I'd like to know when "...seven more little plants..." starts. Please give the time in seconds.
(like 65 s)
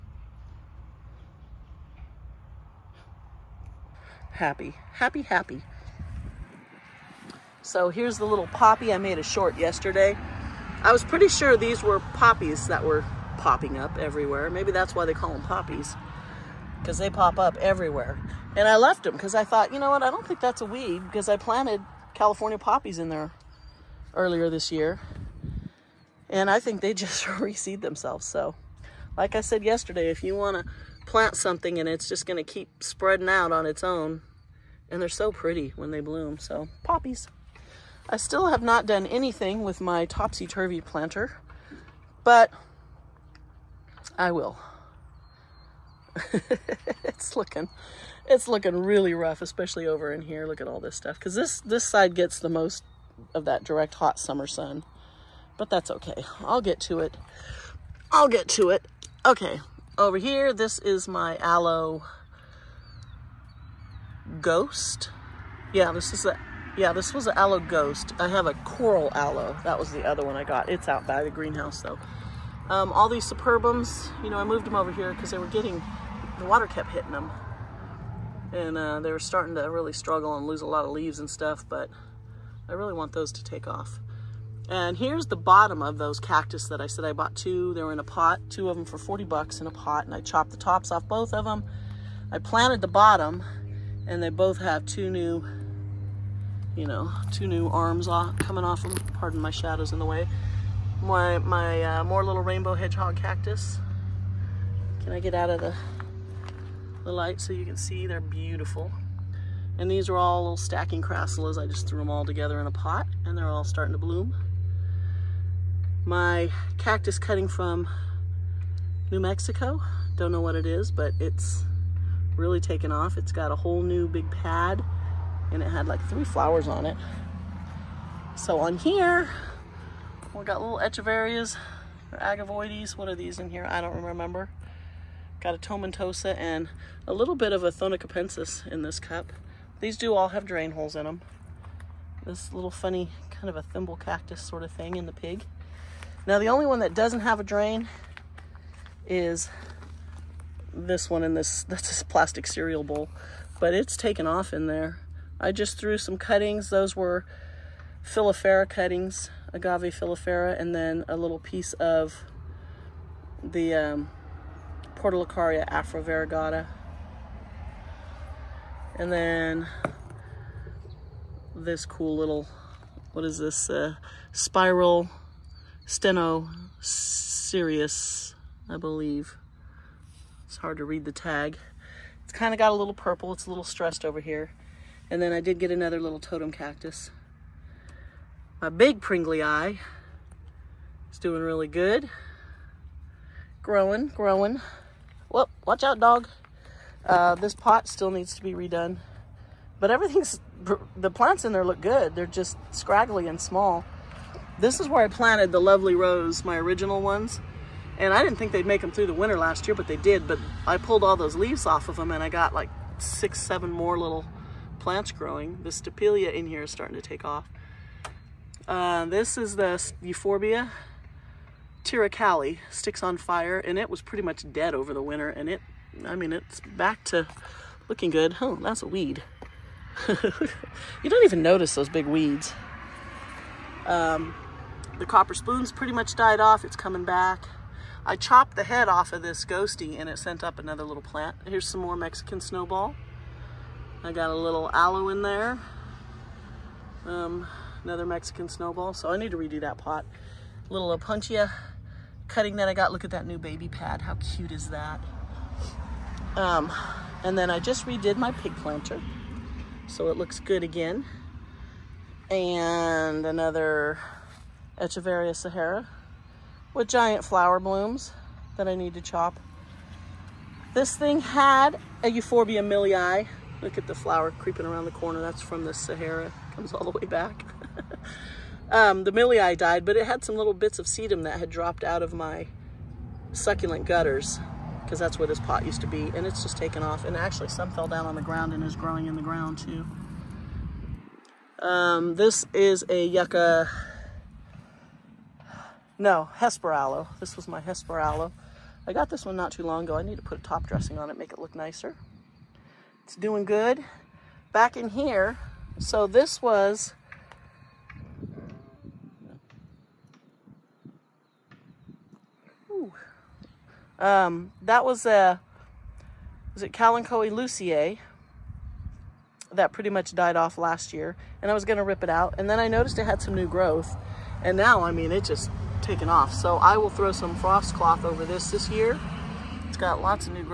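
213 s.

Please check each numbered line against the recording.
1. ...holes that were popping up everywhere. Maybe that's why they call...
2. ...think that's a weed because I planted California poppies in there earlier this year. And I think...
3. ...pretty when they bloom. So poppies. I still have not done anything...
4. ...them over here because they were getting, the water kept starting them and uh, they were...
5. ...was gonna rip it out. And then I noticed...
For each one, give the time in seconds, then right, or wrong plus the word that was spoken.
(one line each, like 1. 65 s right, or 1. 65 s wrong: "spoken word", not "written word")
1. 12 s wrong: "poppies", not "holes"
2. 20 s right
3. 35 s right
4. 74 s wrong: "hitting", not "starting"
5. 321 s right.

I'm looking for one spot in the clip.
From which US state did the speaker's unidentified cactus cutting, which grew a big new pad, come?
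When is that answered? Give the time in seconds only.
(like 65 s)
119 s.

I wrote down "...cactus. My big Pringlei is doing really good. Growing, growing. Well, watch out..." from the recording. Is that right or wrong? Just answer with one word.
right.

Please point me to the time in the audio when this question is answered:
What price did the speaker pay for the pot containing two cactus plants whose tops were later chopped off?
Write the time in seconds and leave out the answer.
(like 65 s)
88 s.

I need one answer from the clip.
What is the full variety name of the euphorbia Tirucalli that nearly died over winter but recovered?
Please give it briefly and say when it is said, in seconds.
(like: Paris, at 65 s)
sticks on fire, at 222 s.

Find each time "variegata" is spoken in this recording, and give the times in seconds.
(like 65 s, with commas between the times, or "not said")
166 s.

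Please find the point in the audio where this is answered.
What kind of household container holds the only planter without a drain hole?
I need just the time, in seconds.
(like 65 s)
152 s.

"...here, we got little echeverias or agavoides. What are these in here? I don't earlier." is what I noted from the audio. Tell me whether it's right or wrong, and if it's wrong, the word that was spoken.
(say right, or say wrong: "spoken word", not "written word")
wrong: "remember", not "earlier".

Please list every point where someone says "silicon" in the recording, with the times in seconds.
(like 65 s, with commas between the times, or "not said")
not said.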